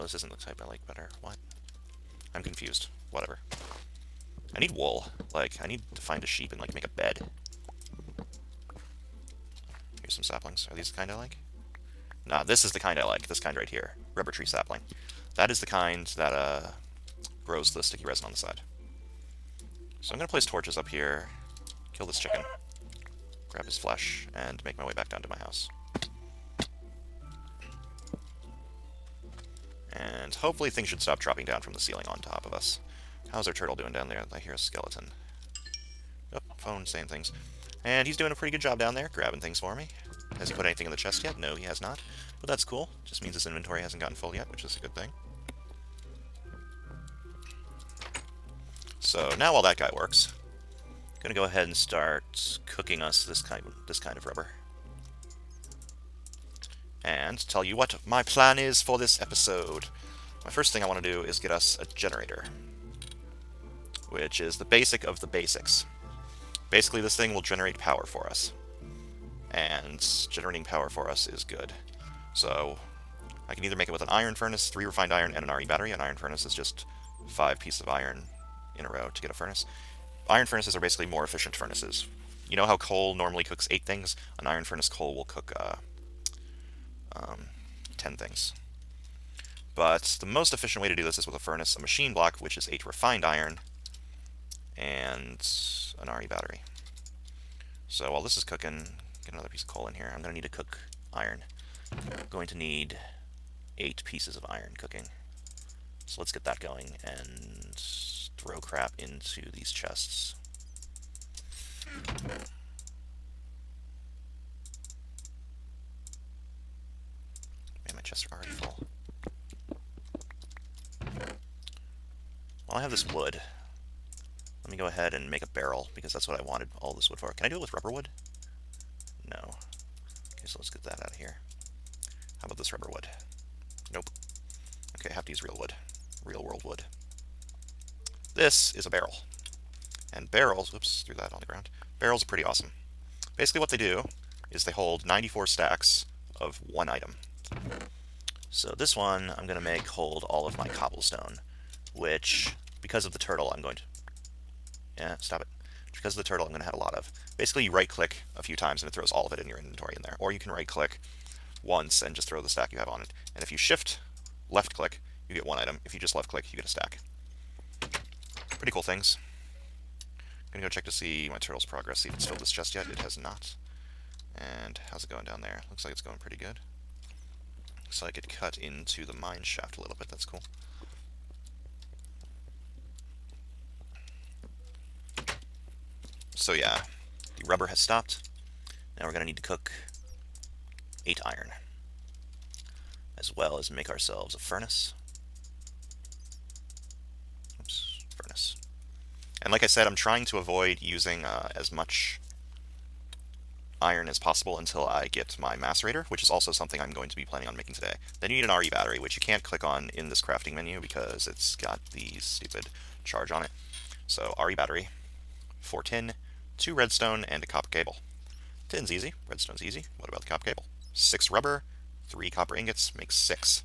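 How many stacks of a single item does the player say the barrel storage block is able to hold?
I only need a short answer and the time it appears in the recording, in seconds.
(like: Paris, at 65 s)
94, at 145 s.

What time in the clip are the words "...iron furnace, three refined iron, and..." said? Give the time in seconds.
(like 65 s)
74 s.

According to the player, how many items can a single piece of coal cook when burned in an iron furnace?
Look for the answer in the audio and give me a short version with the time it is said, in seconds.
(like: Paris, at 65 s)
10, at 87 s.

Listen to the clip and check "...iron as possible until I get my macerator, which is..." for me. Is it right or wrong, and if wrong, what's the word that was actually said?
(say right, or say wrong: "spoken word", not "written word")
right.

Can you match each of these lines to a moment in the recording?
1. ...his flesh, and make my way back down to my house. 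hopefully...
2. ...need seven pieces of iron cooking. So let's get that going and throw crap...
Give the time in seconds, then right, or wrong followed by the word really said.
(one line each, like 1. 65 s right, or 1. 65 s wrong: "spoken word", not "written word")
1. 23 s right
2. 102 s wrong: "eight", not "seven".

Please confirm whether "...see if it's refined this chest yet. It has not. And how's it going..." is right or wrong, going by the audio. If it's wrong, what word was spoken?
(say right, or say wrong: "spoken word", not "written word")
wrong: "filled", not "refined".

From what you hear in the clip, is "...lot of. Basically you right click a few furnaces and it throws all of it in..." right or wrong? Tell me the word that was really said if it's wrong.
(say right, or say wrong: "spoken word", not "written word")
wrong: "times", not "furnaces".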